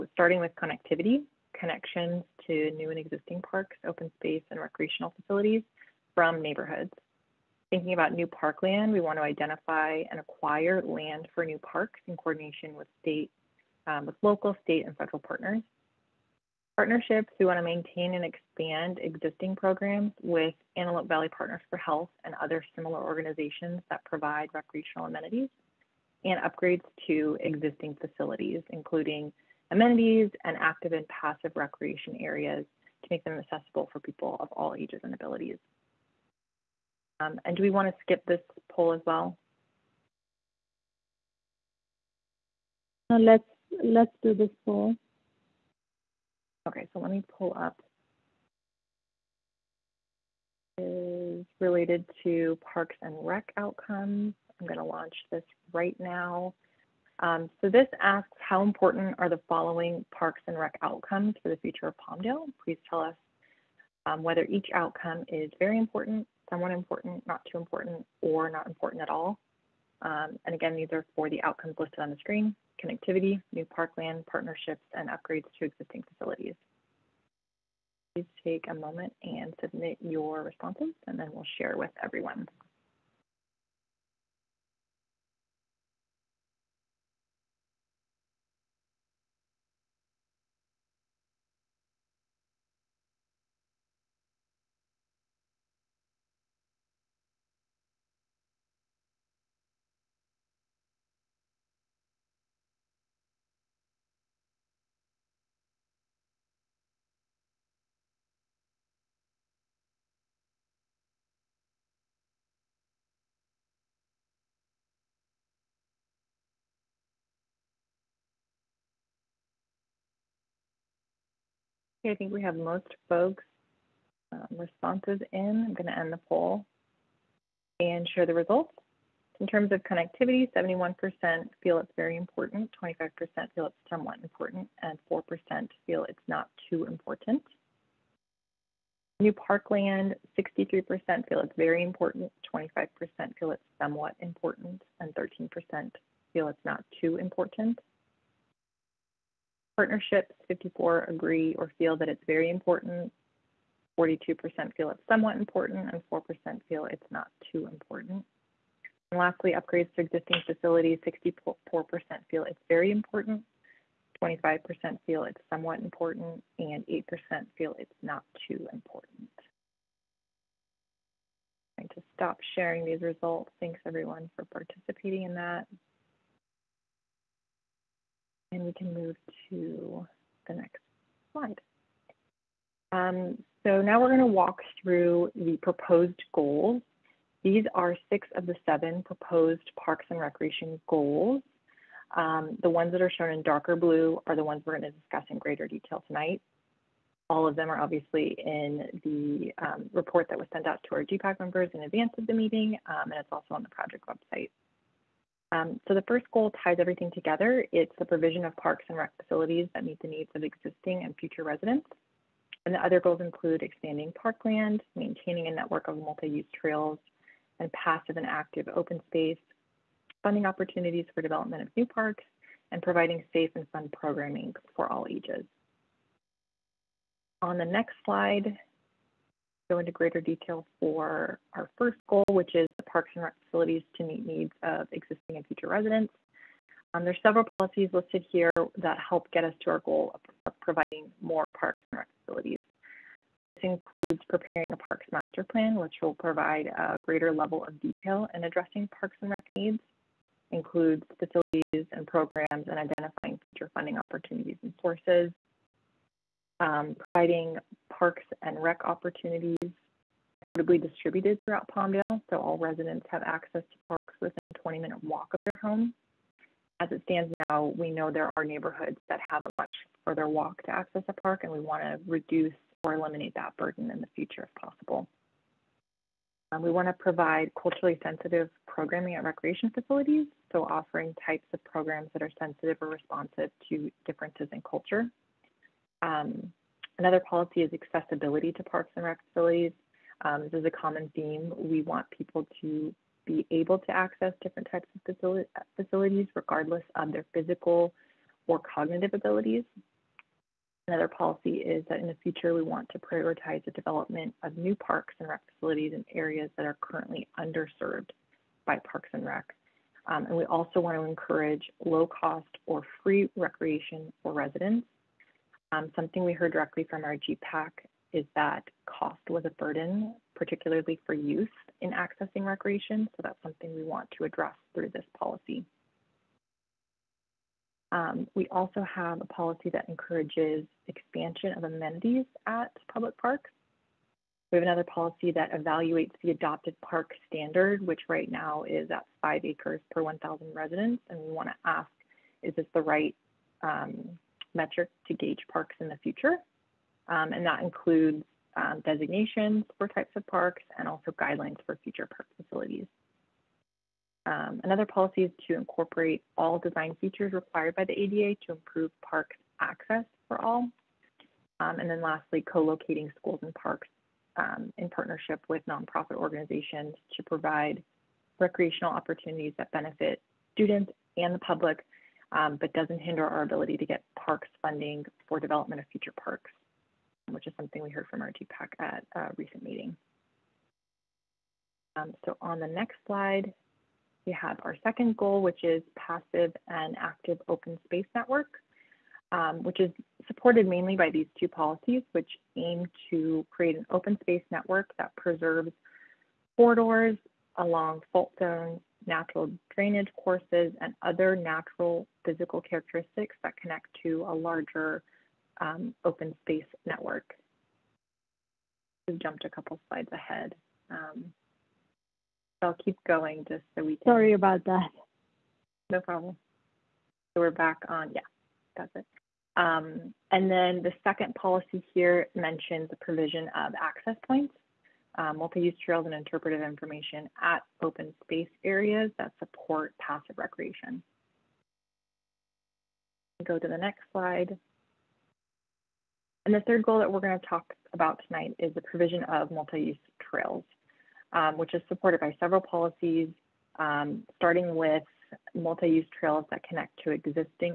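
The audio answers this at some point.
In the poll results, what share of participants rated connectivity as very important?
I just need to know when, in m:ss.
2:10.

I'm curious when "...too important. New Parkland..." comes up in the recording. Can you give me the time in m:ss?
2:16.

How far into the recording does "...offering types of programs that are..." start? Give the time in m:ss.
4:40.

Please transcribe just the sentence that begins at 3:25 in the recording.
Um, so the first goal ties everything together.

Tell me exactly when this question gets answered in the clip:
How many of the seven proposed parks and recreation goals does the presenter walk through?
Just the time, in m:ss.
3:08.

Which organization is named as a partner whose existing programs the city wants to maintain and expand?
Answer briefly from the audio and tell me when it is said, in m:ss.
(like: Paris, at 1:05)
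Antelope Valley Partners for Health, at 0:20.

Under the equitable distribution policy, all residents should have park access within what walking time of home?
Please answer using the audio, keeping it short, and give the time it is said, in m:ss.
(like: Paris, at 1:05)
20 minutes, at 4:24.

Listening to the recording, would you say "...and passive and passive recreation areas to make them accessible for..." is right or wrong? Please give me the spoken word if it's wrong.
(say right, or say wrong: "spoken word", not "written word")
wrong: "active", not "passive".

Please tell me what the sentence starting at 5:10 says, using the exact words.
Um, and we also want to encourage low cost or free recreation for residents.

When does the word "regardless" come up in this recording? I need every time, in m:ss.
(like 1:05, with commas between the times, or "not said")
4:56.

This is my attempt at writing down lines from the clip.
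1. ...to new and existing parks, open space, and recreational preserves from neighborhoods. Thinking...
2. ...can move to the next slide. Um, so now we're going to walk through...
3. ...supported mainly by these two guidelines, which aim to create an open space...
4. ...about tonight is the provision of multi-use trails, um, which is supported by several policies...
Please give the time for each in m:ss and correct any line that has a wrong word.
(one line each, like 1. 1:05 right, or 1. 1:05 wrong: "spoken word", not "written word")
1. 0:02 wrong: "facilities", not "preserves"
2. 2:58 right
3. 6:30 wrong: "policies", not "guidelines"
4. 7:17 right.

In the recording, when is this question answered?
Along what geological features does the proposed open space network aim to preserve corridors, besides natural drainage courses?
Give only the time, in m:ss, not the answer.
6:38.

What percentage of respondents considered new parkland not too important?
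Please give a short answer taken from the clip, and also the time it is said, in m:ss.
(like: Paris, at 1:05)
13%, at 2:25.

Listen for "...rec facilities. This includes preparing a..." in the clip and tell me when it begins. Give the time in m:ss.
4:01.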